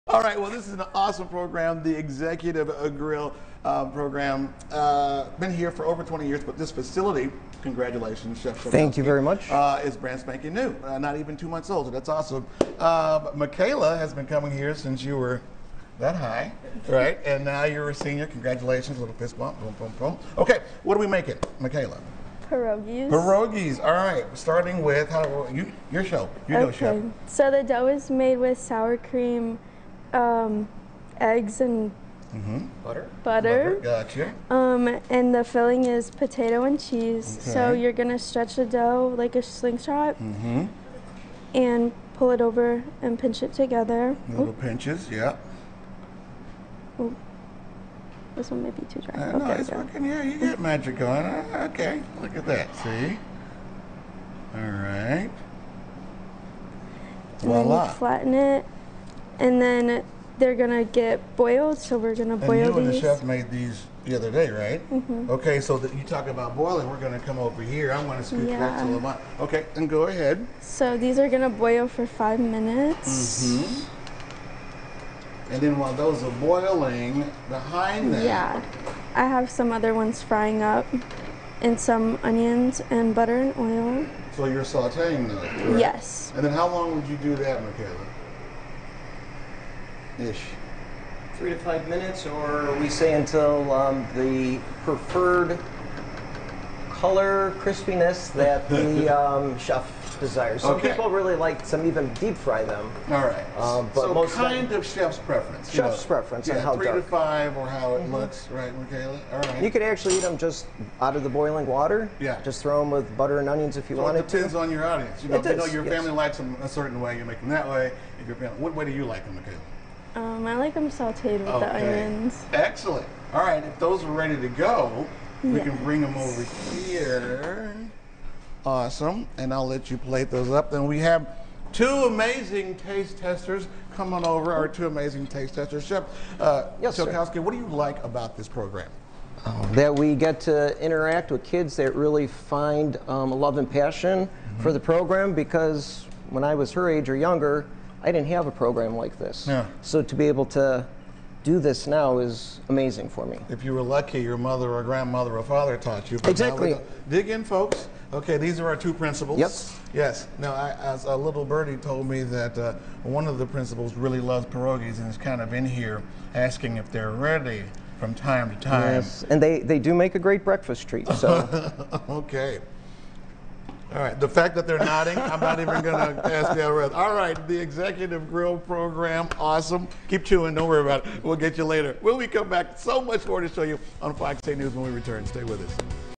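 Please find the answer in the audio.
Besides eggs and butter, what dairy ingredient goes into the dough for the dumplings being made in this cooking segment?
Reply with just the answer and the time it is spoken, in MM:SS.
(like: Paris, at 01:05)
sour cream, at 00:28.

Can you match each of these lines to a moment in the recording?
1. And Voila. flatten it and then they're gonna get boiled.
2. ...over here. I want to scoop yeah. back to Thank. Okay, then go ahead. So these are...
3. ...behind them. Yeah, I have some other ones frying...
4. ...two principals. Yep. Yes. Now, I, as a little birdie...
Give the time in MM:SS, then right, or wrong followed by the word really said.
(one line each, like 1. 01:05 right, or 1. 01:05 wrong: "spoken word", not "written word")
1. 00:57 right
2. 01:07 wrong: "Lamont", not "Thank"
3. 01:17 right
4. 02:38 right.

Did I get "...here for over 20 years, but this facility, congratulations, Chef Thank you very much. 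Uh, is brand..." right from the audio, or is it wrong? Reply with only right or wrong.
right.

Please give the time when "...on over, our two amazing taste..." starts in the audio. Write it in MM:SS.
02:14.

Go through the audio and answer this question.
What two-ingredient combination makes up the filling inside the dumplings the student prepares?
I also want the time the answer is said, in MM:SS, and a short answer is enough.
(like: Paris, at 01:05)
potato and cheese, at 00:36.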